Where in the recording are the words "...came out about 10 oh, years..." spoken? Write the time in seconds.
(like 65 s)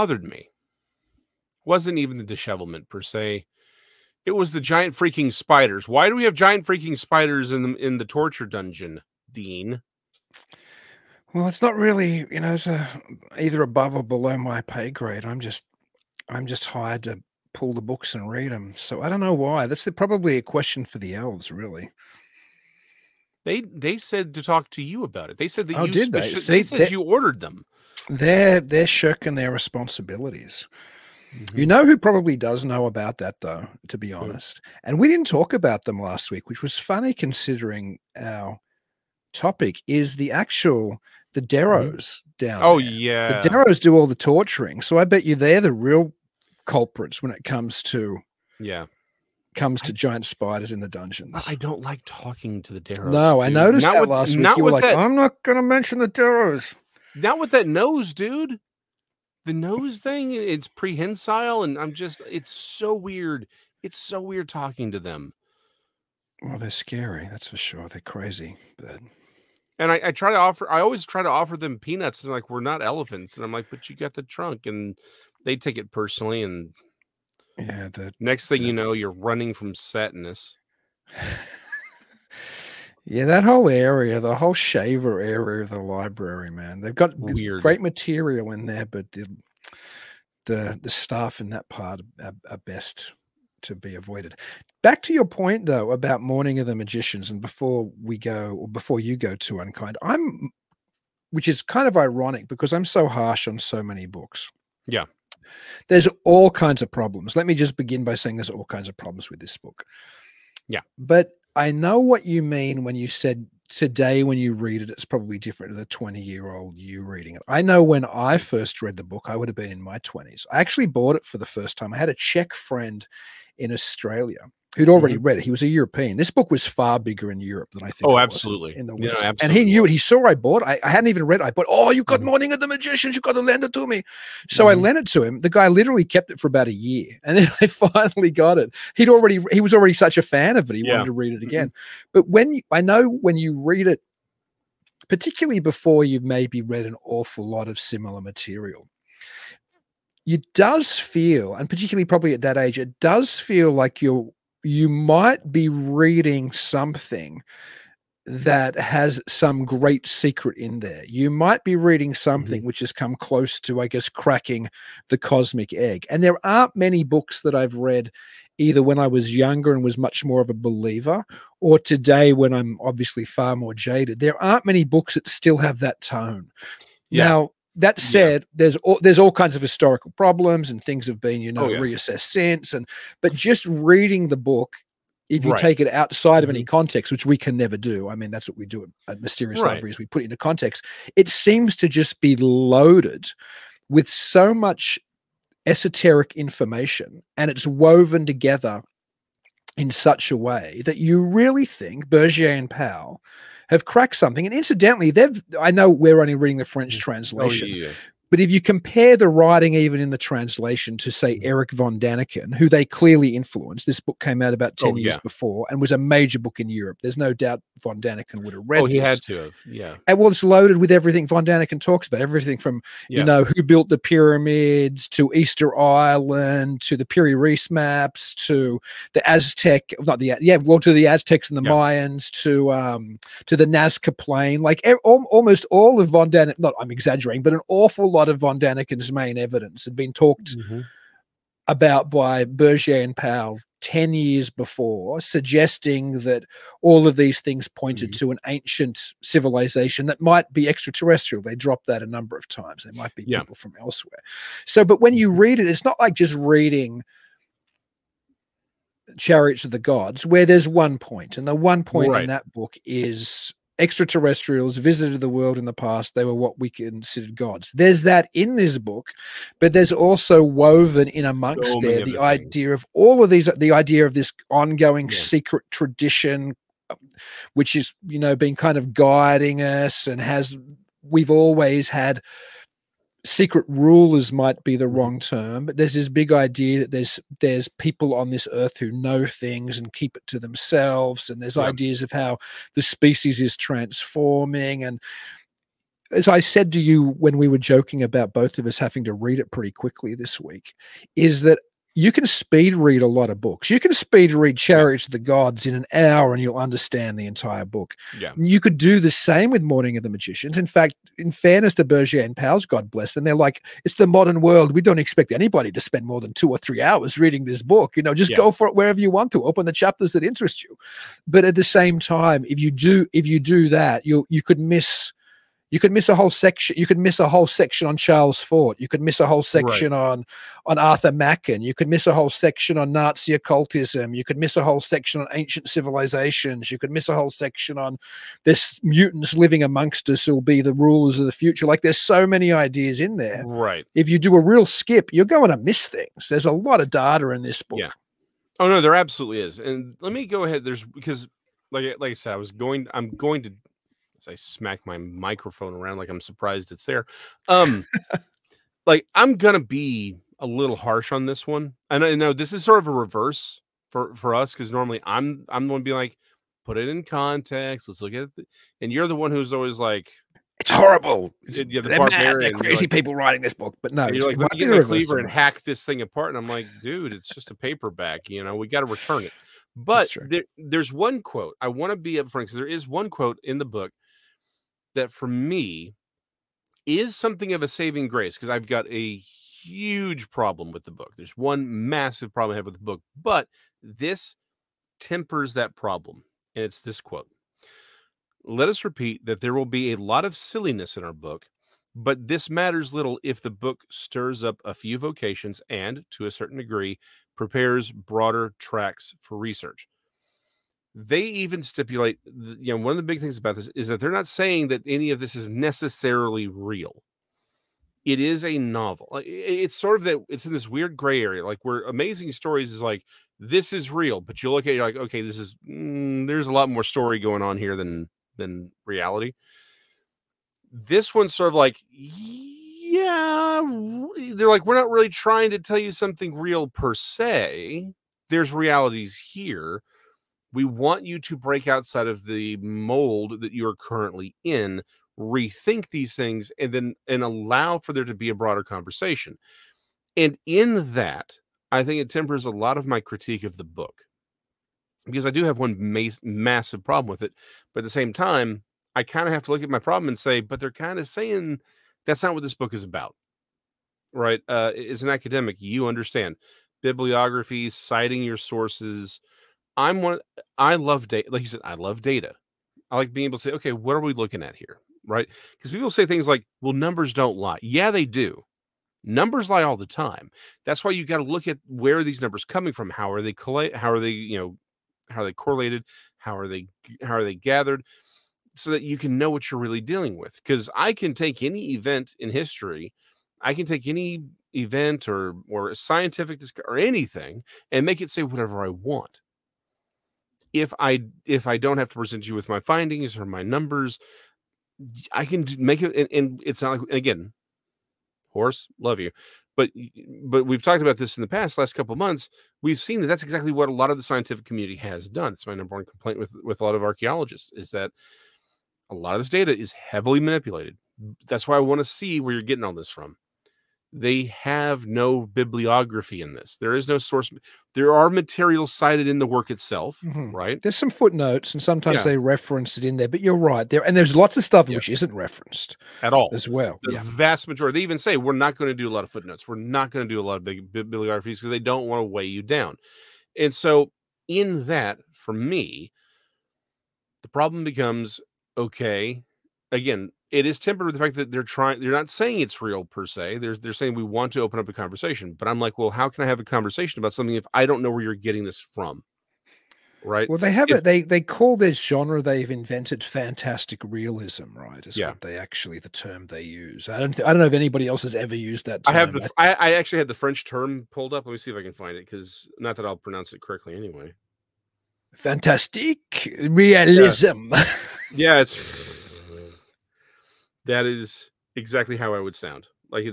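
214 s.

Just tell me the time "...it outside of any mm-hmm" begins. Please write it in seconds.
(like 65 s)
185 s.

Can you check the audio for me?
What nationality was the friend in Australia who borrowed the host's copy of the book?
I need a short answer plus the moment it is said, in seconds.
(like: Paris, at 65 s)
Czech, at 122 s.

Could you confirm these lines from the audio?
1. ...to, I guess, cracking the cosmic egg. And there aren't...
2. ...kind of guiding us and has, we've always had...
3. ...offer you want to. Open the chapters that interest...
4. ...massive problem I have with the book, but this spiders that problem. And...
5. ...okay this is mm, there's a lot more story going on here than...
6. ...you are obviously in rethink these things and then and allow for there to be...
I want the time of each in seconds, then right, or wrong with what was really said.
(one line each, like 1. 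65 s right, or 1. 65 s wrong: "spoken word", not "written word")
1. 163 s right
2. 278 s right
3. 318 s wrong: "wherever", not "offer"
4. 391 s wrong: "tempers", not "spiders"
5. 424 s right
6. 443 s wrong: "currently", not "obviously".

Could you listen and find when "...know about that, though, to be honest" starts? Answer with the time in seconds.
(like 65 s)
32 s.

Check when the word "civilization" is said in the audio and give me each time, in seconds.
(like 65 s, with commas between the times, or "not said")
249 s, 335 s.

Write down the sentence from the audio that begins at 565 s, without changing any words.
what they actually the term they use i don't th- i don't know if anybody else has ever used that term.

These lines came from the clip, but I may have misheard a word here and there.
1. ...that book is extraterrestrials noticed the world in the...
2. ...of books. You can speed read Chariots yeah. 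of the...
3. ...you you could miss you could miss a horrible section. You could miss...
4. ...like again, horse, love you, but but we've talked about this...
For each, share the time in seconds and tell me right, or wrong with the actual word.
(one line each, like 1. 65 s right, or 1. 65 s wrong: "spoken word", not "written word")
1. 262 s wrong: "visited", not "noticed"
2. 303 s right
3. 324 s wrong: "whole", not "horrible"
4. 506 s right.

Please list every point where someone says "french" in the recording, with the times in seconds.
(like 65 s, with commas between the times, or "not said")
206 s, 570 s.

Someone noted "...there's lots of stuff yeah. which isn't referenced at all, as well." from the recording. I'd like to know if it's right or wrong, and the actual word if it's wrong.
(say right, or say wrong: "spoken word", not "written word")
right.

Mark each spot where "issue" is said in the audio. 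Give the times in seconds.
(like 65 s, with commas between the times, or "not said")
not said.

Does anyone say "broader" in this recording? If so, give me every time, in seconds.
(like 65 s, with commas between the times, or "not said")
407 s, 448 s.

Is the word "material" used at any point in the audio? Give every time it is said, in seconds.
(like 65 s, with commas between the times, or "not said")
87 s, 148 s, 528 s.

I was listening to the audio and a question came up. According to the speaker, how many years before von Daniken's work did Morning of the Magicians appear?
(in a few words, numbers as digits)
10 years.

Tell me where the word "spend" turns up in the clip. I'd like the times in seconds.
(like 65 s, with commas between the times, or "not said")
315 s.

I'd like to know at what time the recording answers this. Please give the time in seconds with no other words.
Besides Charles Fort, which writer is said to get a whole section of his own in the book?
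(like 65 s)
330 s.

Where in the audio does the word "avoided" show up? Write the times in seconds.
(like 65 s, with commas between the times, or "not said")
93 s.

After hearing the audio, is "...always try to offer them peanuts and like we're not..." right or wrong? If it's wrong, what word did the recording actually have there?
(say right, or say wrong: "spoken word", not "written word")
right.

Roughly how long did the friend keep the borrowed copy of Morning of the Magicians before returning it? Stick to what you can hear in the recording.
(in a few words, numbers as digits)
About a year.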